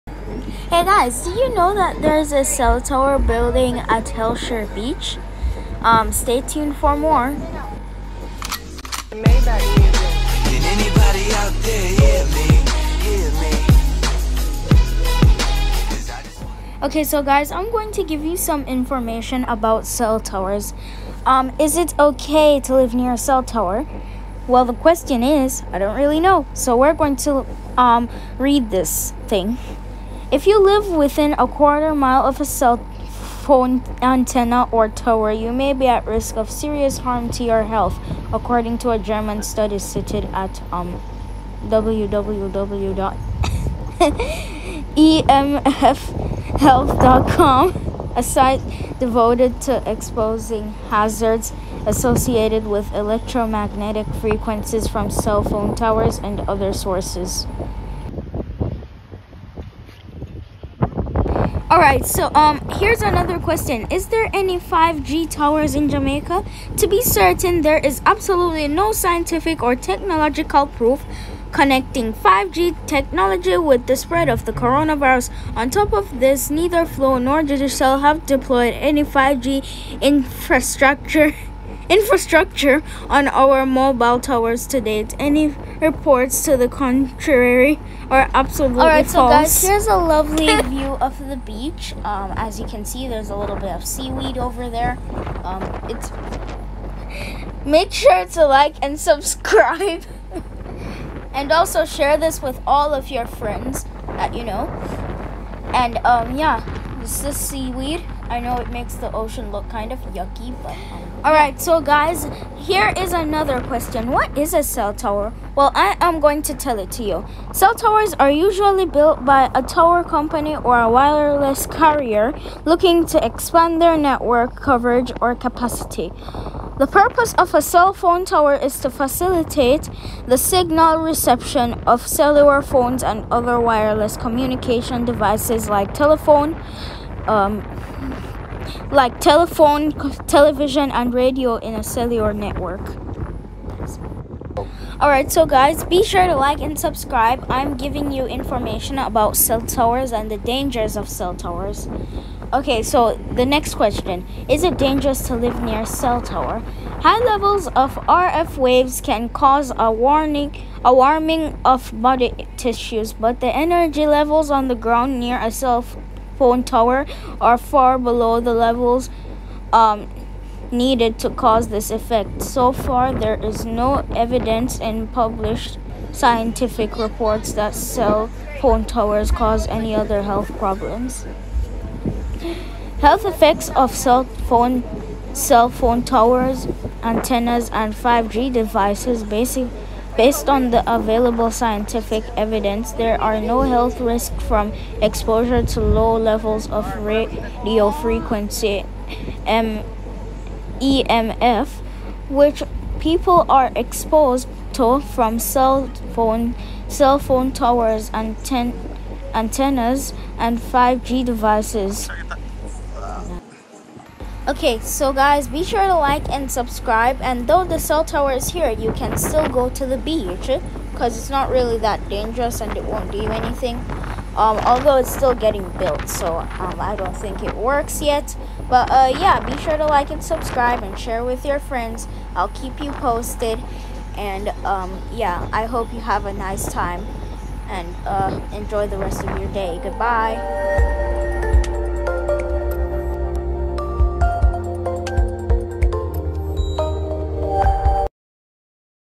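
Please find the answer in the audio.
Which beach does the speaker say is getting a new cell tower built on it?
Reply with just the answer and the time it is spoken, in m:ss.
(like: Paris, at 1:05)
Hellshire Beach, at 0:04.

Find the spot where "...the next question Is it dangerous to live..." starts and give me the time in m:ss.
2:33.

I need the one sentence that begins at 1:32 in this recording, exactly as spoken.
Um, as you can see, there's a little bit of seaweed over there.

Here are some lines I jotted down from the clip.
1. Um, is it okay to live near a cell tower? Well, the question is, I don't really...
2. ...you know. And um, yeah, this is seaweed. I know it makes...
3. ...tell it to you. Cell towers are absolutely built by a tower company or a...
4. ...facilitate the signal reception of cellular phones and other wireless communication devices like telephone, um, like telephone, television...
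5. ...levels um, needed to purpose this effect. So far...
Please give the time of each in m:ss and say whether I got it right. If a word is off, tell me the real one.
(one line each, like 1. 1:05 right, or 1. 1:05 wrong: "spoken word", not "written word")
1. 0:21 right
2. 1:44 right
3. 1:56 wrong: "usually", not "absolutely"
4. 2:08 right
5. 2:48 wrong: "cause", not "purpose".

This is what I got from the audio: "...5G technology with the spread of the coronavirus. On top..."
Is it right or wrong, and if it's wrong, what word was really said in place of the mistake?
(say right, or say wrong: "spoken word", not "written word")
right.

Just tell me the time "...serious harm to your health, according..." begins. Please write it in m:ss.
0:36.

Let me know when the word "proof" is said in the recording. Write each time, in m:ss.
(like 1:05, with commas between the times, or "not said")
1:10.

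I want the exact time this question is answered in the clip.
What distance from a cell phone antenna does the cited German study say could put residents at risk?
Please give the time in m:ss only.
0:31.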